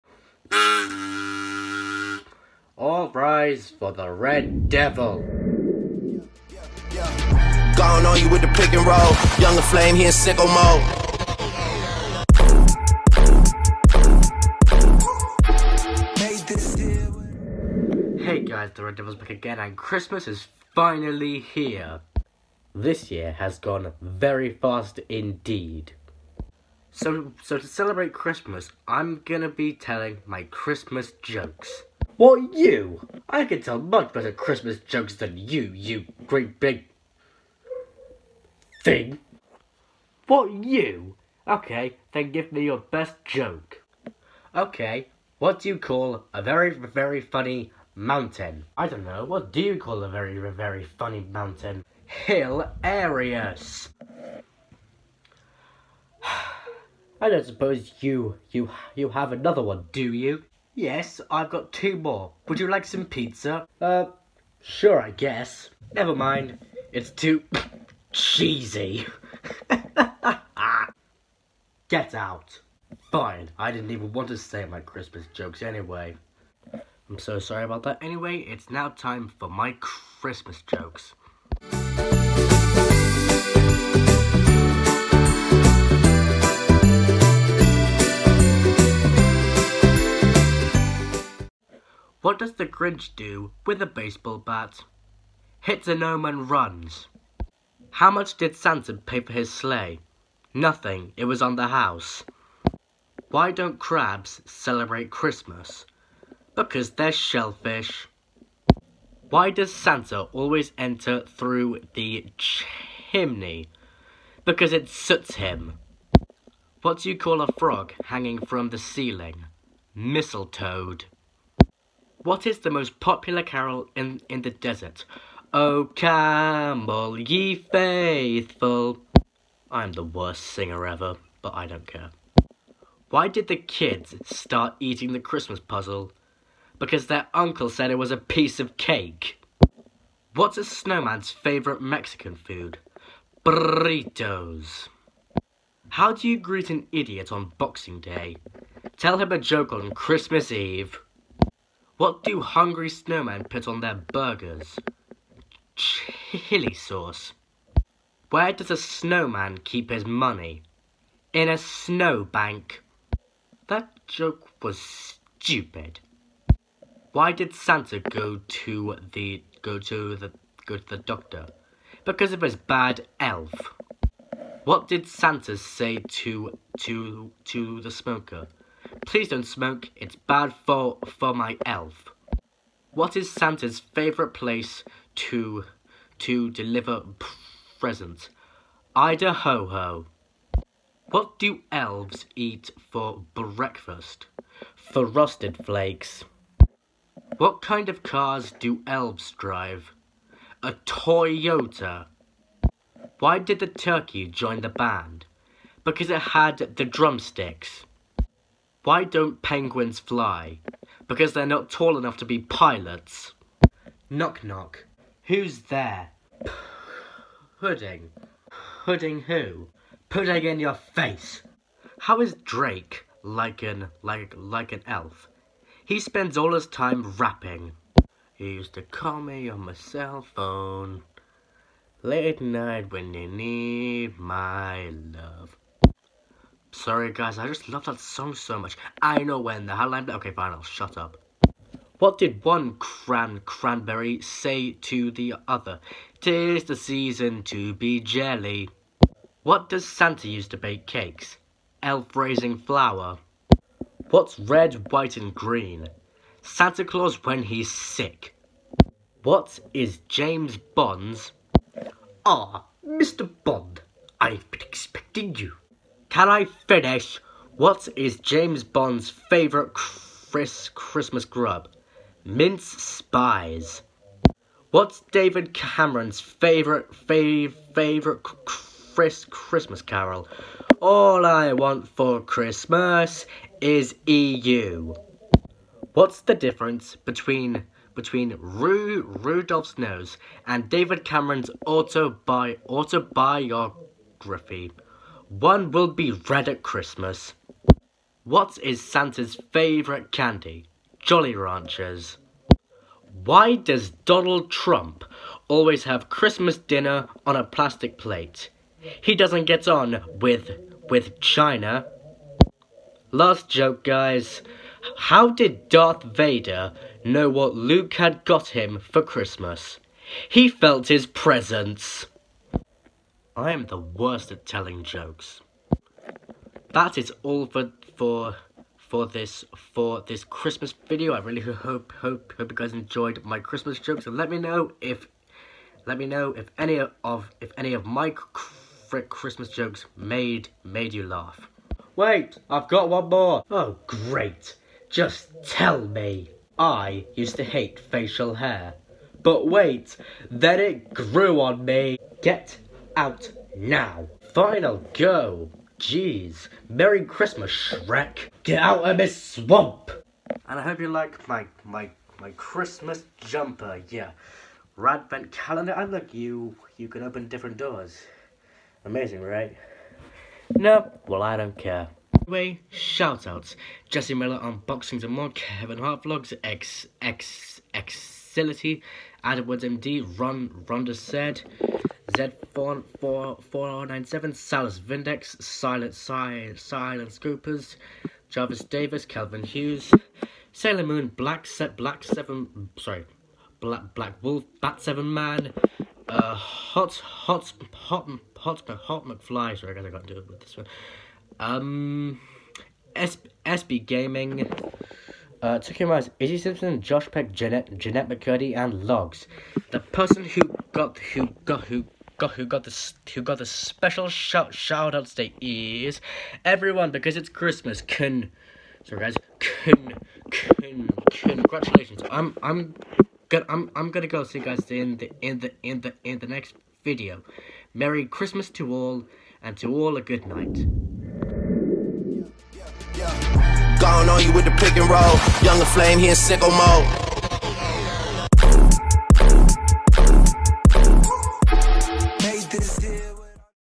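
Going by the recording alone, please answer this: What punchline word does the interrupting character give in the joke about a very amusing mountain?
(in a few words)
Hilarious.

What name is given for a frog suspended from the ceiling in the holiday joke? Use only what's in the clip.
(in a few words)
Mistletoed.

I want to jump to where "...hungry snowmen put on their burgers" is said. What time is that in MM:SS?
02:32.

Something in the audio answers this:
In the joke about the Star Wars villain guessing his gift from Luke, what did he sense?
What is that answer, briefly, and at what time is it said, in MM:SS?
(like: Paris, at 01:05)
His presence, at 05:20.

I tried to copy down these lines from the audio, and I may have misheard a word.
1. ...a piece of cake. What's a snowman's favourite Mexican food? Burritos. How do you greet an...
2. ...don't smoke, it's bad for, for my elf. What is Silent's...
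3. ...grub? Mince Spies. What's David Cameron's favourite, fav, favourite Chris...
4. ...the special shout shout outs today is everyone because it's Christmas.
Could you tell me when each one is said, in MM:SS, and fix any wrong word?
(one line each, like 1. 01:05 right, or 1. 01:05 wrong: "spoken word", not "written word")
1. 02:18 right
2. 02:59 wrong: "Santa", not "Silent"
3. 04:31 right
4. 06:53 right.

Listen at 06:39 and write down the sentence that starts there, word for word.
Sorry, guess I got to do it with this one.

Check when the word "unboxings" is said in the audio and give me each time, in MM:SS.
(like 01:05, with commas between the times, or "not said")
06:14.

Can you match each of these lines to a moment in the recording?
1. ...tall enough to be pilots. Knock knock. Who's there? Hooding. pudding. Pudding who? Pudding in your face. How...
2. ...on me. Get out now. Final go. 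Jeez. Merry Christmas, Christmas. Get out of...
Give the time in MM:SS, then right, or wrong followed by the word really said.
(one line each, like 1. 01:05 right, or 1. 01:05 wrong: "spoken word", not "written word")
1. 03:31 right
2. 05:51 wrong: "Shrek", not "Christmas".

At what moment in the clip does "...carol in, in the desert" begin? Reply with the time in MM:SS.
02:03.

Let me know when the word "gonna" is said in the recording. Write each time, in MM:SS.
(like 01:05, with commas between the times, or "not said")
00:29, 07:03.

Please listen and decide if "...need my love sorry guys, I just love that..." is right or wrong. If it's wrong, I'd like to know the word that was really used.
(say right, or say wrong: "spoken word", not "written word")
right.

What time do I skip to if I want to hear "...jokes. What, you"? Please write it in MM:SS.
00:31.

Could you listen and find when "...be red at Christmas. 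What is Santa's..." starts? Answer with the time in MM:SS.
04:55.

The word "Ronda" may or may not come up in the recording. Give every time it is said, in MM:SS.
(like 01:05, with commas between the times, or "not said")
06:20.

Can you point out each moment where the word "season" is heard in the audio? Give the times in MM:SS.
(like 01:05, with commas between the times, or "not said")
04:06.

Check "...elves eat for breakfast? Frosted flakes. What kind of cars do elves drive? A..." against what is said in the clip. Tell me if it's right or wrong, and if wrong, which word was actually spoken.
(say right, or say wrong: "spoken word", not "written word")
right.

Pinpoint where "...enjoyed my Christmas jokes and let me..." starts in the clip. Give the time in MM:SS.
05:32.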